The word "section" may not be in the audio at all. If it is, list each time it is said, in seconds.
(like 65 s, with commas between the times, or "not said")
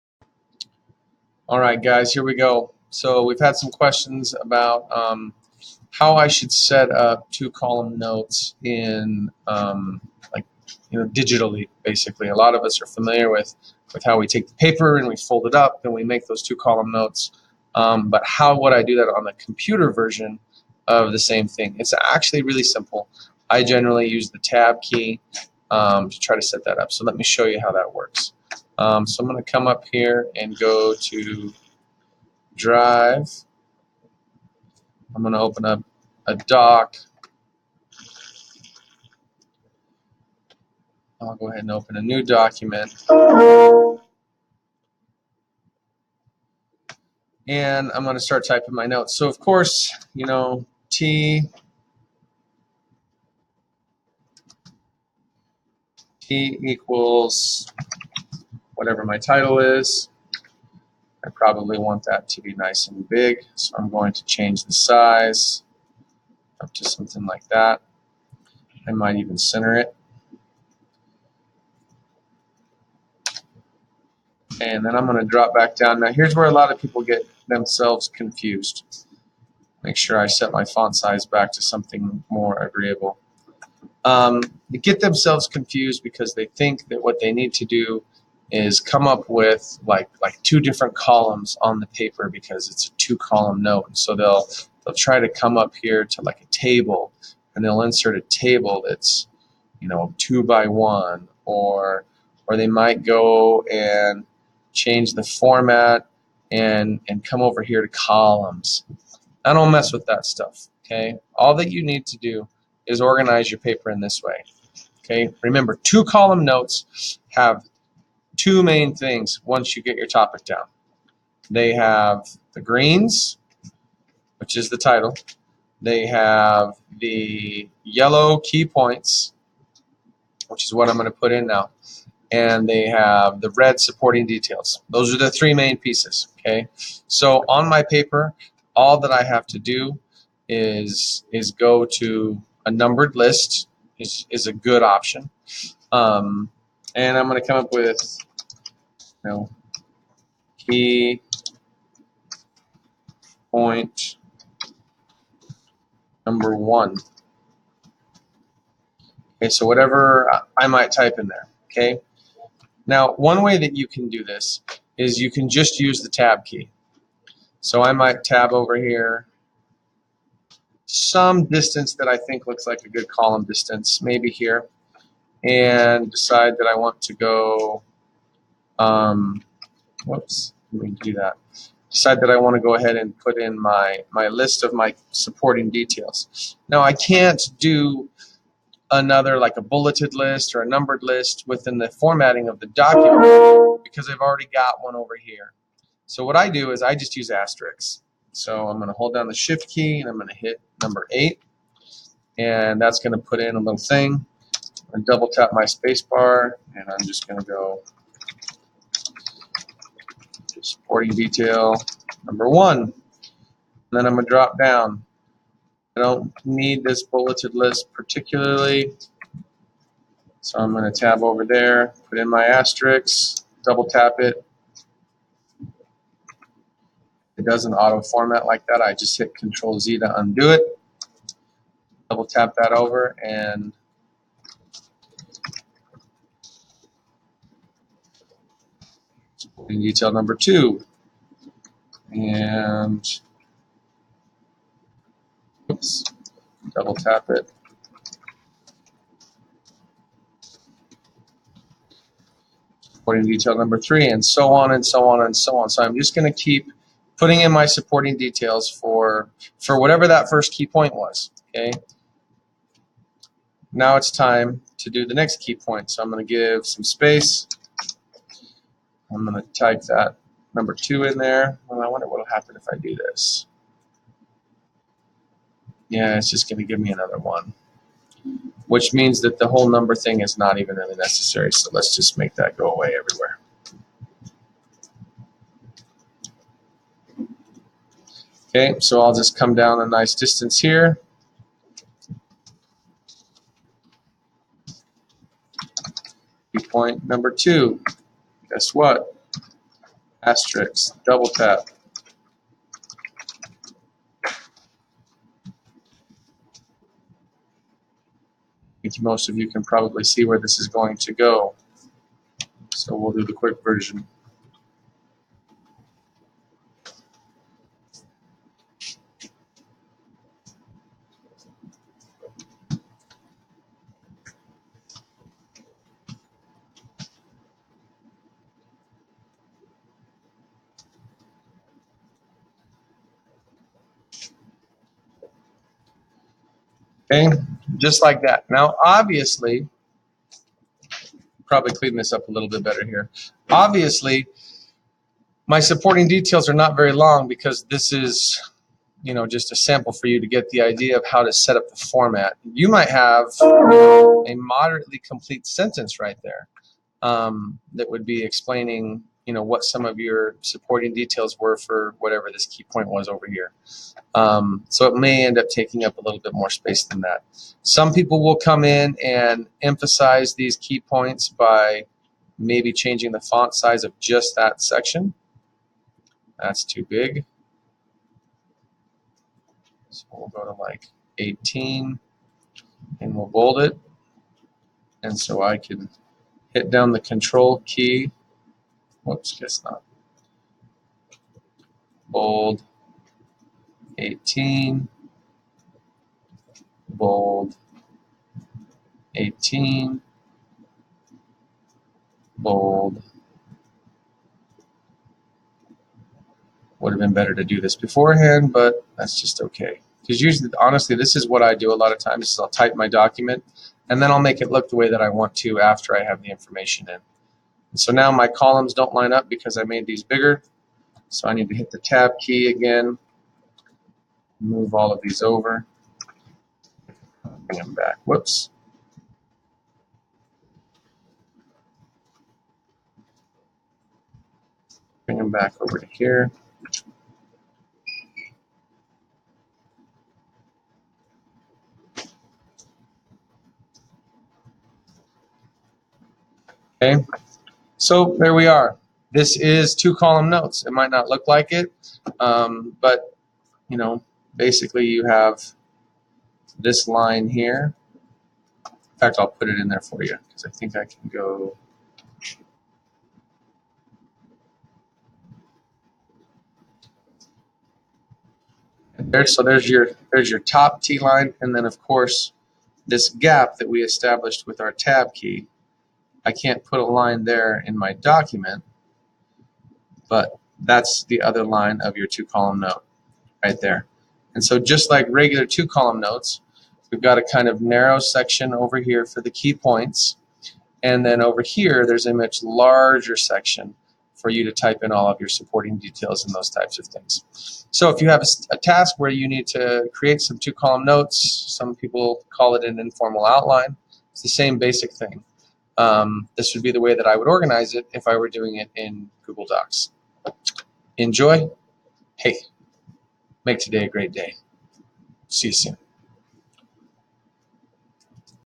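374 s, 487 s, 493 s.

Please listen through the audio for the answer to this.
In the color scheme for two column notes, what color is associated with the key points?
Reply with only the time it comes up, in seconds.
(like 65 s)
127 s.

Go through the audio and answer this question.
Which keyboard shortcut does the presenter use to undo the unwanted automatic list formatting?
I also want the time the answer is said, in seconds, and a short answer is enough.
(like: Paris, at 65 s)
Control Z, at 229 s.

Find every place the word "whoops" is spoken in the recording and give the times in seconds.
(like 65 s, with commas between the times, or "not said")
180 s, 389 s, 428 s.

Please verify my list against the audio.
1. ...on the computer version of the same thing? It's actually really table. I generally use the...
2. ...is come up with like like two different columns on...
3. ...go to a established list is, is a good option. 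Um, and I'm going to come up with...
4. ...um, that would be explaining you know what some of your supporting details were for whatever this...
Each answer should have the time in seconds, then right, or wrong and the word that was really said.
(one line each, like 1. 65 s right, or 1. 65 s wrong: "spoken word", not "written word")
1. 19 s wrong: "simple", not "table"
2. 88 s right
3. 141 s wrong: "numbered", not "established"
4. 357 s right.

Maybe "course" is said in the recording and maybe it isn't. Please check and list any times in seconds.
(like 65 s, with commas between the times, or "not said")
49 s, 471 s.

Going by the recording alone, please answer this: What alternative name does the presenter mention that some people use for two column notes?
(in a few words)
informal outline.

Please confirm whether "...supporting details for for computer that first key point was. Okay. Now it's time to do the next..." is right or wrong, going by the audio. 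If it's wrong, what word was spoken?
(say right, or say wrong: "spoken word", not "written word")
wrong: "whatever", not "computer".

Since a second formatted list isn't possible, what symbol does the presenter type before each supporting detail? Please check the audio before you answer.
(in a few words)
asterisks.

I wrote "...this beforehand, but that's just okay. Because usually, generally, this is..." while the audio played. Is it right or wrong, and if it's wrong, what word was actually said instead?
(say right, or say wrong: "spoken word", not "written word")
wrong: "honestly", not "generally".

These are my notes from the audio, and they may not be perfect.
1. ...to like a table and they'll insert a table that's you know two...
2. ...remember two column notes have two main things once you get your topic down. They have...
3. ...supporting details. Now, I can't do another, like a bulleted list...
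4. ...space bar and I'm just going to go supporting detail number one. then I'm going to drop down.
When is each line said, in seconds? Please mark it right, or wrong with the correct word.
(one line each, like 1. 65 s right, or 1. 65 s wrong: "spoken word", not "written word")
1. 96 s right
2. 115 s right
3. 185 s right
4. 205 s right.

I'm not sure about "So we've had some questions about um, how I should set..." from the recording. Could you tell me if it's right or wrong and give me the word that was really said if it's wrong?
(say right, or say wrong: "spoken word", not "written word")
right.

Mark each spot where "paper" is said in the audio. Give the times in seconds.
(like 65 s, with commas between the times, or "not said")
14 s, 91 s, 113 s, 137 s.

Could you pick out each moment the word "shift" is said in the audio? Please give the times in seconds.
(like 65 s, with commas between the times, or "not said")
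199 s.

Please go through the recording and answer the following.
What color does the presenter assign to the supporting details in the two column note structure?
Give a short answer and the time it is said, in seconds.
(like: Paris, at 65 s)
red, at 133 s.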